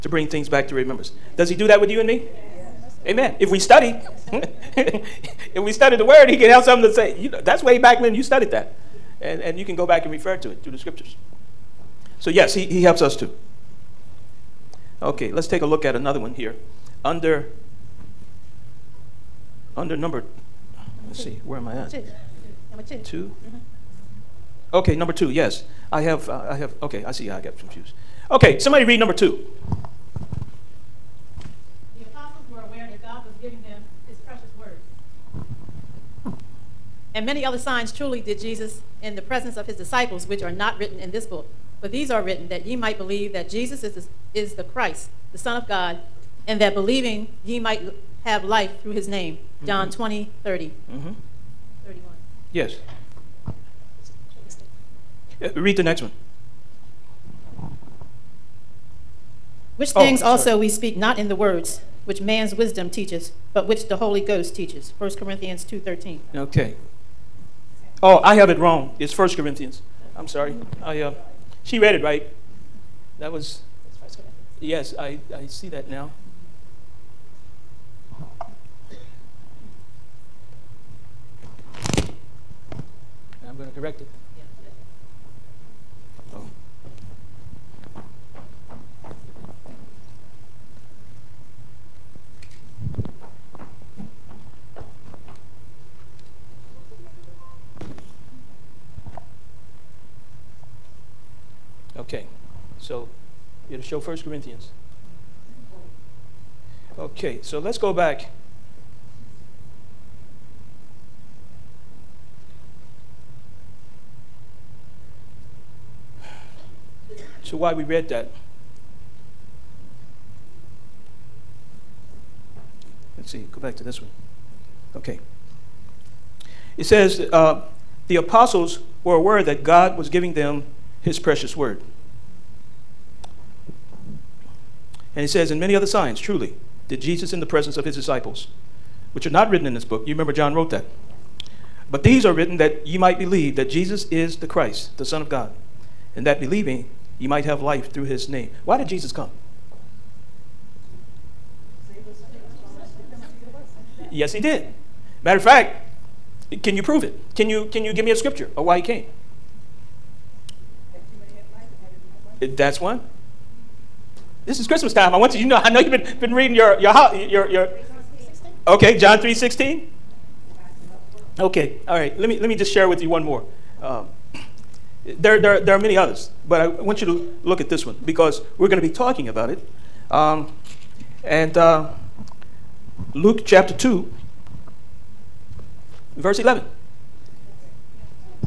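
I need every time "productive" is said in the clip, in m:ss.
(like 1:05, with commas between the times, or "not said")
not said.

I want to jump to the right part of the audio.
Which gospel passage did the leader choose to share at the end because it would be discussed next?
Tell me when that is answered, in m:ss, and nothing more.
3:03.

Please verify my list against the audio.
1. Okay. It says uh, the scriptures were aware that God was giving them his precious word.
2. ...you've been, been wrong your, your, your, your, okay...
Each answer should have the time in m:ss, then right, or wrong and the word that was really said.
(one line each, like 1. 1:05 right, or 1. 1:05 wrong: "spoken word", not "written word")
1. 2:04 wrong: "apostles", not "scriptures"
2. 2:45 wrong: "reading", not "wrong".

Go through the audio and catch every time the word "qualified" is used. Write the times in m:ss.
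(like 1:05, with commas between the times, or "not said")
not said.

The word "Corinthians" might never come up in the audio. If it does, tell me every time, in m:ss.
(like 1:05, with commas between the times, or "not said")
1:05, 1:09, 1:44.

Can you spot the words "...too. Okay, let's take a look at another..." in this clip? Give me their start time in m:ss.
0:13.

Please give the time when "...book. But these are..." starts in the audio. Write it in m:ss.
0:41.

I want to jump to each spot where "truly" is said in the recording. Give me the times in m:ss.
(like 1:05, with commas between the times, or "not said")
0:37, 2:16.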